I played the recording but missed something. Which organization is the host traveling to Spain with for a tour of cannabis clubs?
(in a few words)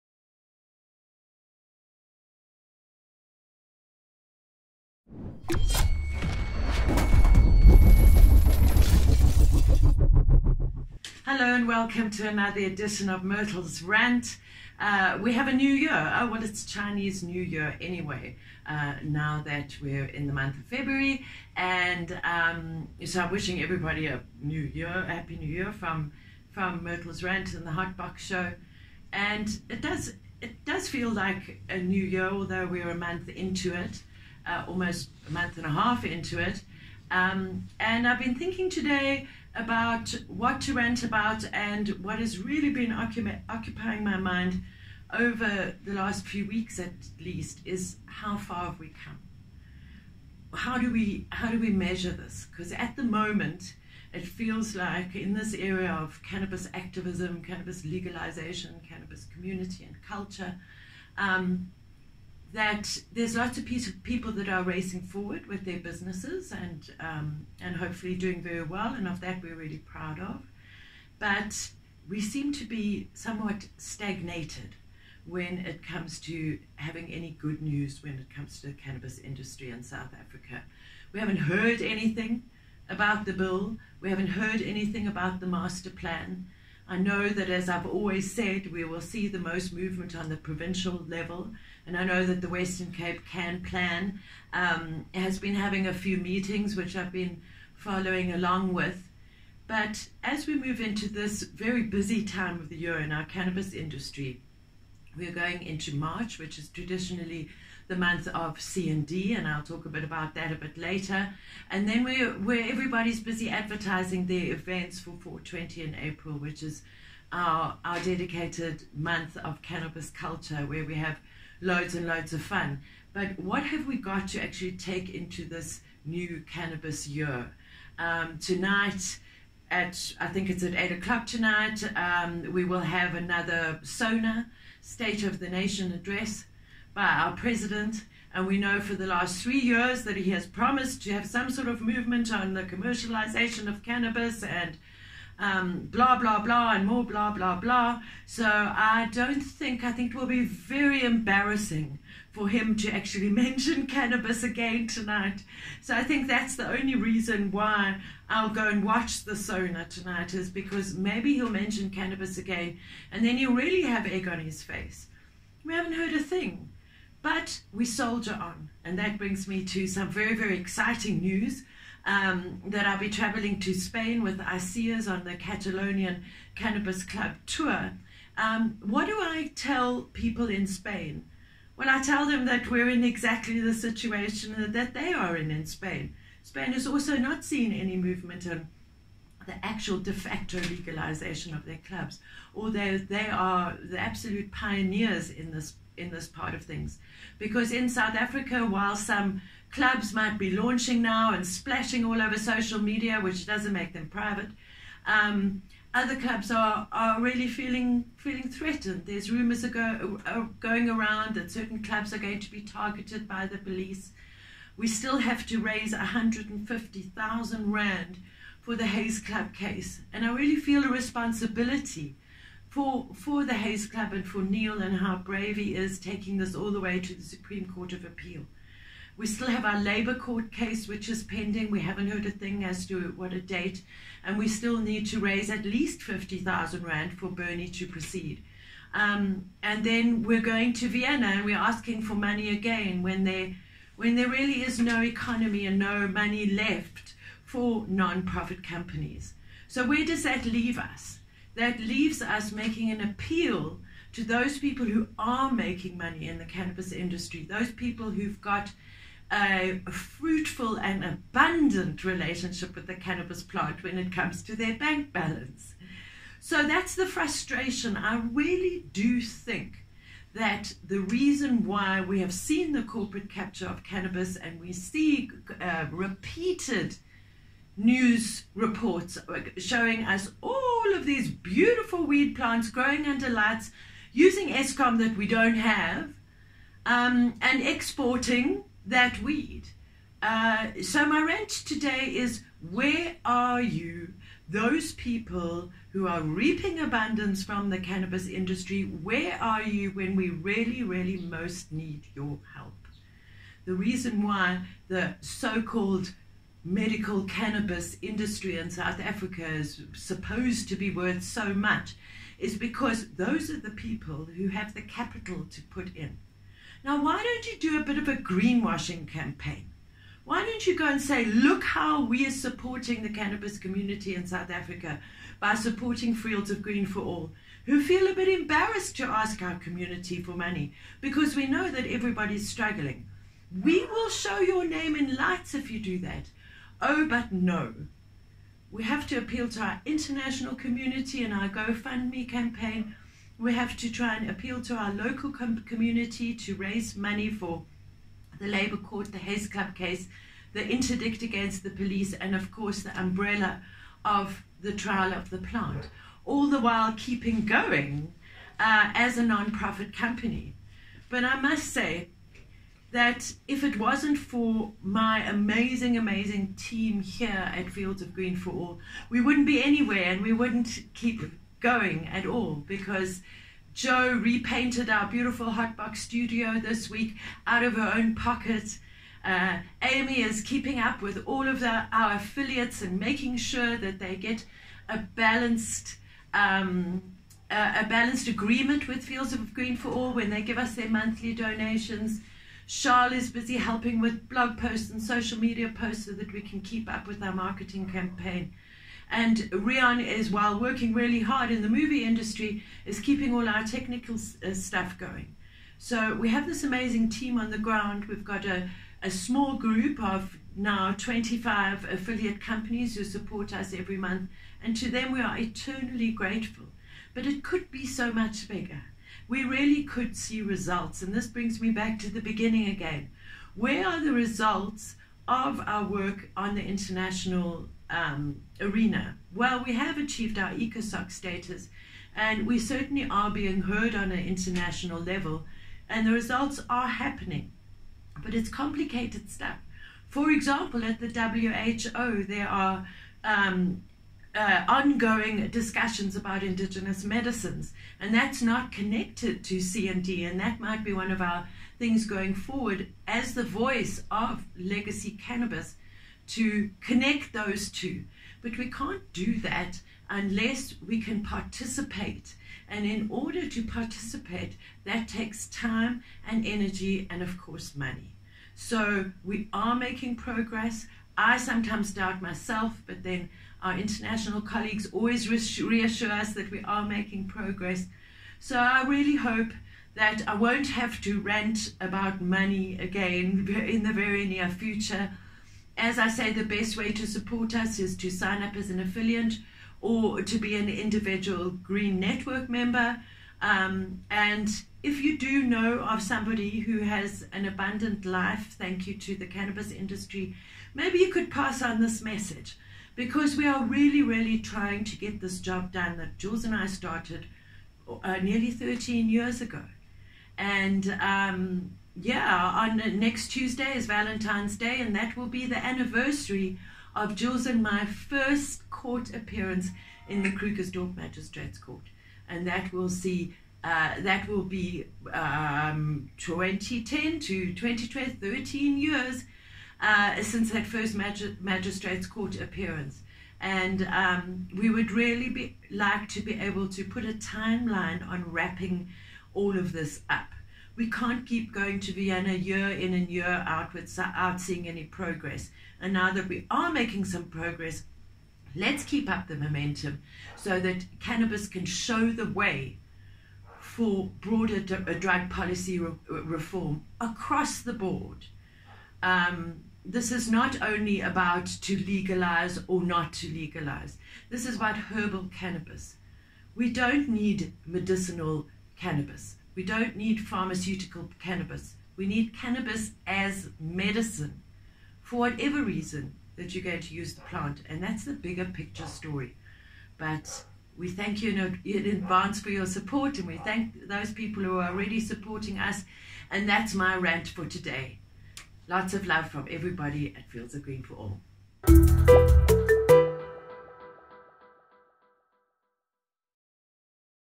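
ICEERS.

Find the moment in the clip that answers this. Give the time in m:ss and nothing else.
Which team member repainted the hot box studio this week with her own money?
6:13.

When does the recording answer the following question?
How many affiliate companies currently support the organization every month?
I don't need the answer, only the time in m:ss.
6:50.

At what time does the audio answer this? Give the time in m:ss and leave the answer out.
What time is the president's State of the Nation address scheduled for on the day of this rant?
2:10.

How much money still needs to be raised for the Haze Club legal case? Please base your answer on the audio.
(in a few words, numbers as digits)
150,000 rand.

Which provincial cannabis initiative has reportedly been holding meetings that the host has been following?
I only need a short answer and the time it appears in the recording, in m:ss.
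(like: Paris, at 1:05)
Western Cape Can Plan, at 1:32.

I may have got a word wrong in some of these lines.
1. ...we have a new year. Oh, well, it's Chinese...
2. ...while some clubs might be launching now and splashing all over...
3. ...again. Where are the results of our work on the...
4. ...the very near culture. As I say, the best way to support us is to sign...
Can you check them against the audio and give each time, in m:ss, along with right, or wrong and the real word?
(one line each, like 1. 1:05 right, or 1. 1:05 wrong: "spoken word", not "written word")
1. 0:15 right
2. 3:18 right
3. 7:02 right
4. 8:03 wrong: "future", not "culture".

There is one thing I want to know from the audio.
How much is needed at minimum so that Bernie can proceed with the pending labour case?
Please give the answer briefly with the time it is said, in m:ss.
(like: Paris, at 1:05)
50,000 rand, at 3:56.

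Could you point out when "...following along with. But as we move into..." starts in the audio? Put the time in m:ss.
1:37.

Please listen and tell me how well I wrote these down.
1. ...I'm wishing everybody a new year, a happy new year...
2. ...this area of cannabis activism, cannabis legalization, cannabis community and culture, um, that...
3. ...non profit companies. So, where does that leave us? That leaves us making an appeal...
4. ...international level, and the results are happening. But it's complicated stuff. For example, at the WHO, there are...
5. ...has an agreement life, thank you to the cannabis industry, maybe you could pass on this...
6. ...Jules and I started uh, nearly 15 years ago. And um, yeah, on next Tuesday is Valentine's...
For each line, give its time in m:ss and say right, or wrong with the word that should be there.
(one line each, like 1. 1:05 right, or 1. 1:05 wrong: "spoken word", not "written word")
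1. 0:23 right
2. 0:55 right
3. 4:07 right
4. 7:14 right
5. 8:16 wrong: "abundant", not "agreement"
6. 8:26 wrong: "13", not "15".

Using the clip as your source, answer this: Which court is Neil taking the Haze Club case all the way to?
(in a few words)
Supreme Court of Appeal.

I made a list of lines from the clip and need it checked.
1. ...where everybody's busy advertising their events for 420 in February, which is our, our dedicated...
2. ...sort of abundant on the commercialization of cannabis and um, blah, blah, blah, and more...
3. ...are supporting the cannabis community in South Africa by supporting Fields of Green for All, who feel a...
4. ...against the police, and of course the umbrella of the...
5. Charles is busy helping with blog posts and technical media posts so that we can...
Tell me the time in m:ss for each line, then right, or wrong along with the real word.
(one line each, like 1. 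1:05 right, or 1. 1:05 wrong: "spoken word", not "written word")
1. 1:52 wrong: "April", not "February"
2. 2:21 wrong: "movement", not "abundant"
3. 5:22 right
4. 5:51 right
5. 6:32 wrong: "social", not "technical".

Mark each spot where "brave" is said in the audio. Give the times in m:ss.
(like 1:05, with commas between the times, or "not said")
3:45.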